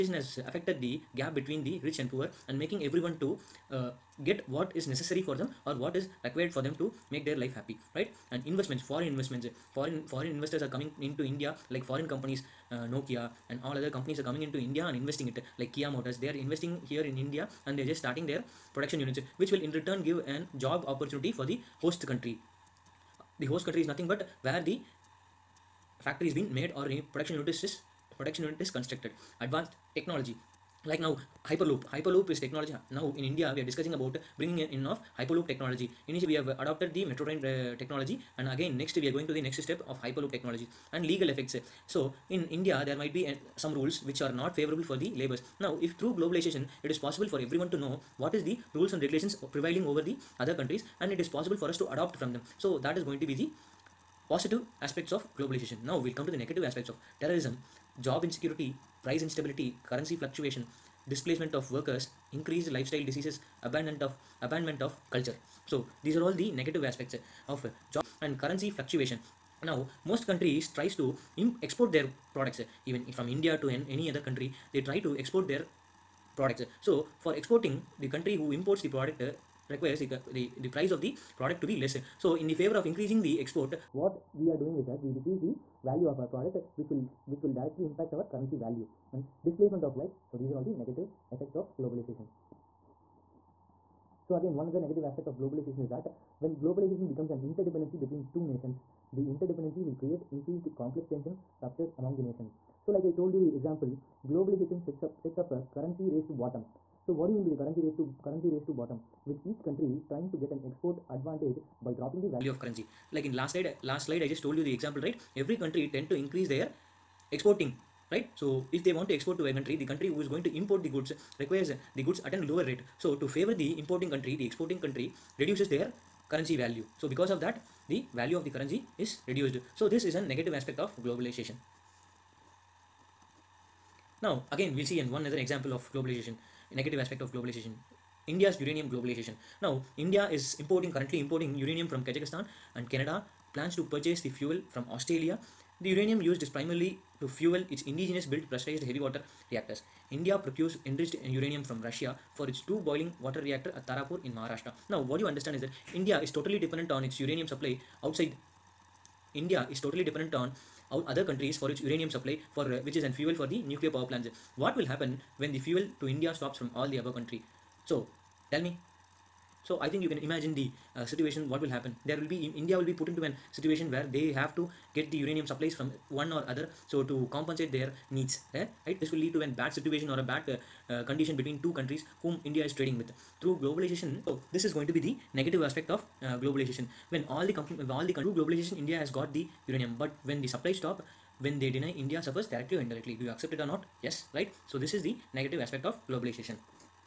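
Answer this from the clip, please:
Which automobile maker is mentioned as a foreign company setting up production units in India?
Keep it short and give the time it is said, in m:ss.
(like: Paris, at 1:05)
Kia Motors, at 0:15.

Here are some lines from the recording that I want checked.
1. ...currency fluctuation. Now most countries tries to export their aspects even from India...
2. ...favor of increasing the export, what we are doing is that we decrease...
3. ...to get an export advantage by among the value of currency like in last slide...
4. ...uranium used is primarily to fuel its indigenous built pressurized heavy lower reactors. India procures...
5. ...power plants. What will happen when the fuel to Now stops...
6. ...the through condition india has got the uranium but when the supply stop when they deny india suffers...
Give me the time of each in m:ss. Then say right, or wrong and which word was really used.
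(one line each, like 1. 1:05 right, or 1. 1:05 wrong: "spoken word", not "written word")
1. 1:08 wrong: "products", not "aspects"
2. 1:22 right
3. 1:50 wrong: "dropping", not "among"
4. 2:25 wrong: "water", not "lower"
5. 2:43 wrong: "India", not "Now"
6. 3:08 wrong: "globalization", not "condition".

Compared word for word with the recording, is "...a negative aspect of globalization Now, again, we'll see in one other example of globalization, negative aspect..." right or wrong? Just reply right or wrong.
right.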